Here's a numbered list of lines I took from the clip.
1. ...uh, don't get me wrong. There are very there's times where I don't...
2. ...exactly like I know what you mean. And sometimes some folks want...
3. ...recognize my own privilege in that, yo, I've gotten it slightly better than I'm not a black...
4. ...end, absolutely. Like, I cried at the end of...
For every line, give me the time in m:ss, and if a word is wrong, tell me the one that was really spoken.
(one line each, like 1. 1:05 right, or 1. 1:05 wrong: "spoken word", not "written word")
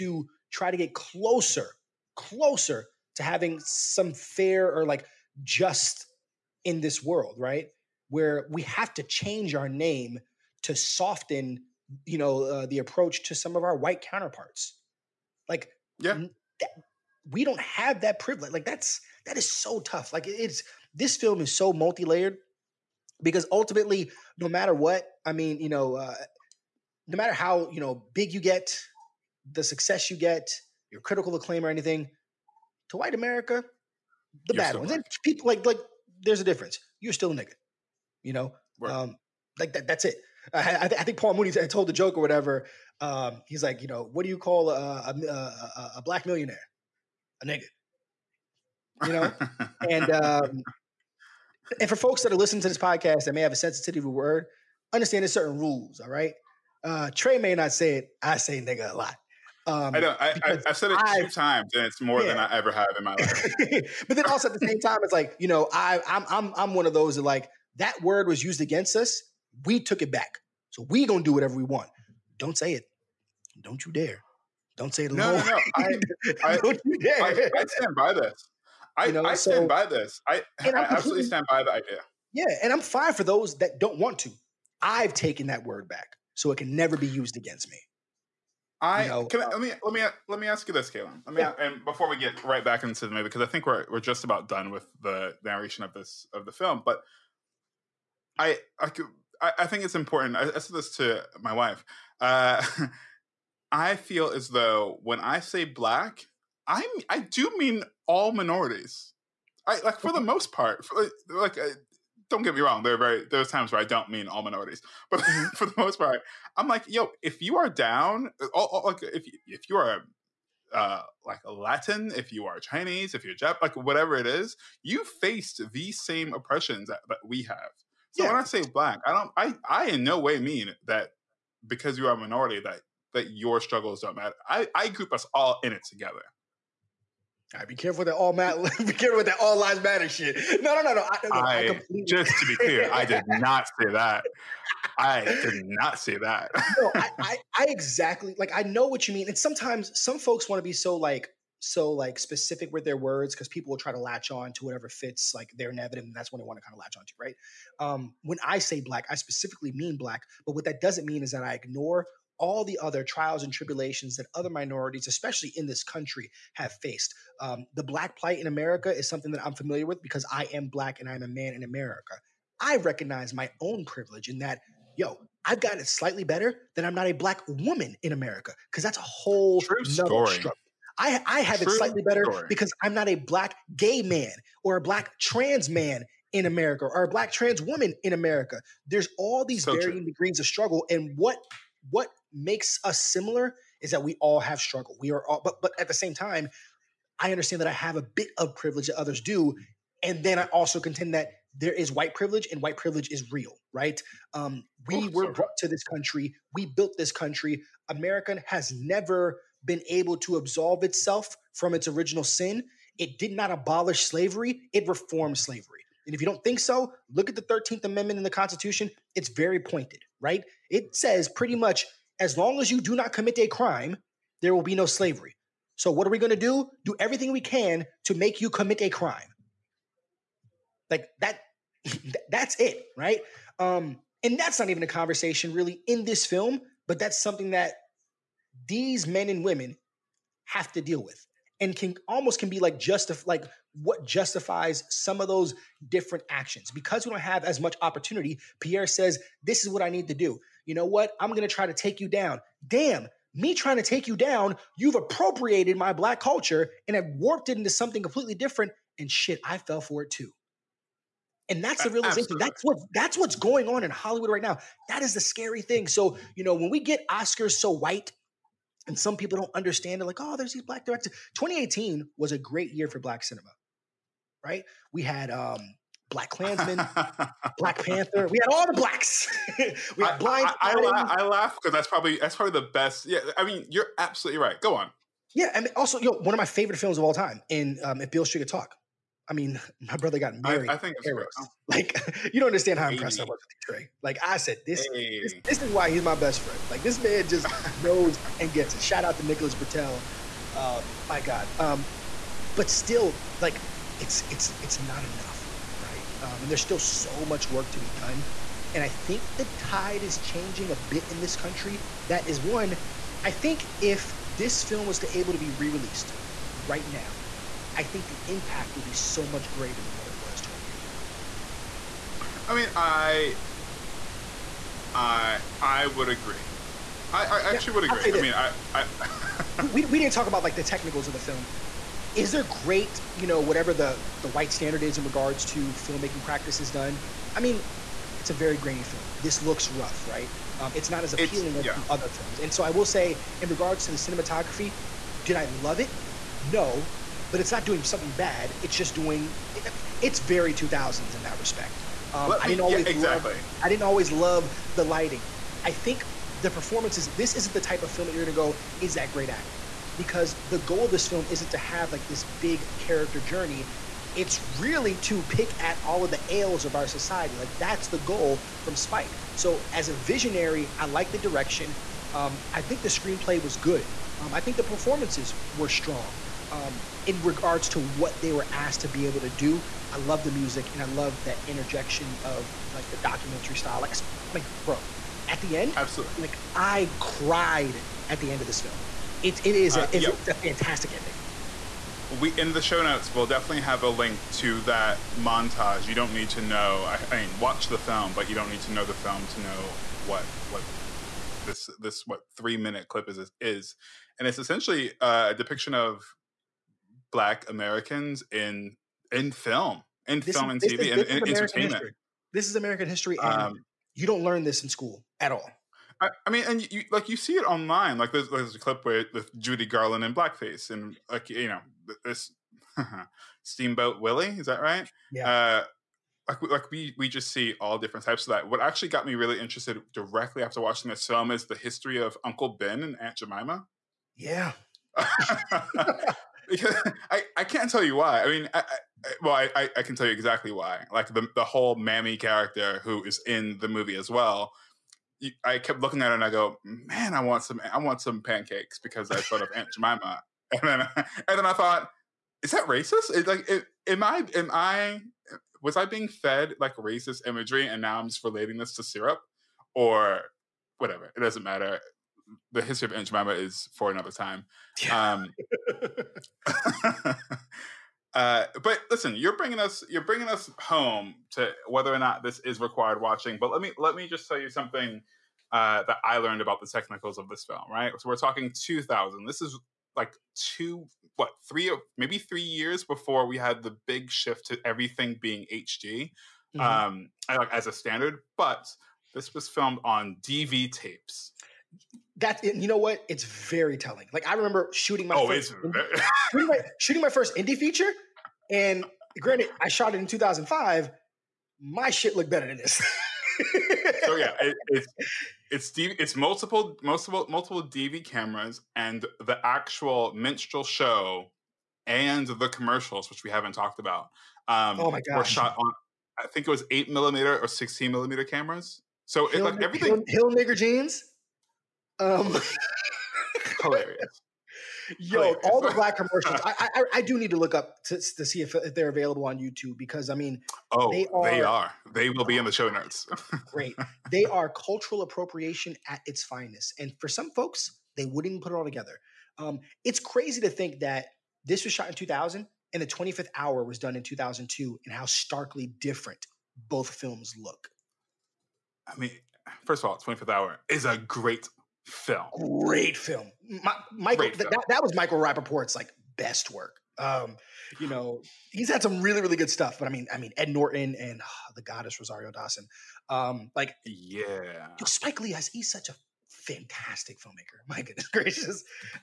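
1. 1:51 right
2. 2:27 right
3. 2:52 right
4. 6:25 right.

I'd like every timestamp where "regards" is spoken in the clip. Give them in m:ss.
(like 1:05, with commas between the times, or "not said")
5:35, 5:43, 6:17.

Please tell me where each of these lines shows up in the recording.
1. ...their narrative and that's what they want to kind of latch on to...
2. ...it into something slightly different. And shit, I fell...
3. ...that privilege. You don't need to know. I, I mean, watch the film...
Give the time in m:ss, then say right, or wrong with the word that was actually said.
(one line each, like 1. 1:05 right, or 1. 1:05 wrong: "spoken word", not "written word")
1. 2:35 right
2. 4:17 wrong: "completely", not "slightly"
3. 6:34 wrong: "montage", not "privilege".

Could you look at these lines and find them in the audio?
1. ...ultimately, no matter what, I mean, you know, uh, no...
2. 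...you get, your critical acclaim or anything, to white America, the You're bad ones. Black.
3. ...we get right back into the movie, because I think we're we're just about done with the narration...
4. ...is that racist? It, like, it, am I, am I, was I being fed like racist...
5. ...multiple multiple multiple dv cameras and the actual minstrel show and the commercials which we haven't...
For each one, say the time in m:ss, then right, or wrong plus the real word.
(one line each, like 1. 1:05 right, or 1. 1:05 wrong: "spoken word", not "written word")
1. 0:23 right
2. 0:30 right
3. 1:32 right
4. 7:32 right
5. 8:26 right.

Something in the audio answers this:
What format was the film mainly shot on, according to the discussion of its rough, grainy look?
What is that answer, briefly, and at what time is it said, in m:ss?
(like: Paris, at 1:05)
DV tapes, at 8:10.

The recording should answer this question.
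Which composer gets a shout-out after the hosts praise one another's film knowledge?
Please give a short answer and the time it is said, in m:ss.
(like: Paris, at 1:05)
Nicholas Britell, at 4:59.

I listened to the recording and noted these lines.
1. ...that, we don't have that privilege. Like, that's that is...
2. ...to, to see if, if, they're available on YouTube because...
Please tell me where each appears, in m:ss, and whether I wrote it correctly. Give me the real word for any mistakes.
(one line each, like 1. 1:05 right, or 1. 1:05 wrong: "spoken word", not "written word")
1. 0:16 right
2. 8:47 right.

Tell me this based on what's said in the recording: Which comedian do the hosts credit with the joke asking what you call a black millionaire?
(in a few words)
Paul Mooney.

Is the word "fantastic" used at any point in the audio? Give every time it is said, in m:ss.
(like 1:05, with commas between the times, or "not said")
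6:30, 9:26.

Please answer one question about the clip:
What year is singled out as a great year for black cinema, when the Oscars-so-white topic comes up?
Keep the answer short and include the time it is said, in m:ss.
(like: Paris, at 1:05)
2018, at 4:31.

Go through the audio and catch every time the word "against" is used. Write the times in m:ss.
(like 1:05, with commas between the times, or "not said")
1:08, 1:27.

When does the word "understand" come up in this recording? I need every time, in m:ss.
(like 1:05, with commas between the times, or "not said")
0:54, 3:17, 4:29, 4:52.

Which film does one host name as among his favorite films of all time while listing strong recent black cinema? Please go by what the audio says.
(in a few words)
If Beale Street Could Talk.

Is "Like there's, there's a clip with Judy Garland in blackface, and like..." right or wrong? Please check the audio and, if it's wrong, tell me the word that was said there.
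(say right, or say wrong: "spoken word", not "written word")
right.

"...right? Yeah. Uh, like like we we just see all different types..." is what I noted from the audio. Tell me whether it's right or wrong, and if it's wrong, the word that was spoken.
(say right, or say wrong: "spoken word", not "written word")
right.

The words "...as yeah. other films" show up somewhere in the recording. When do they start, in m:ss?
5:41.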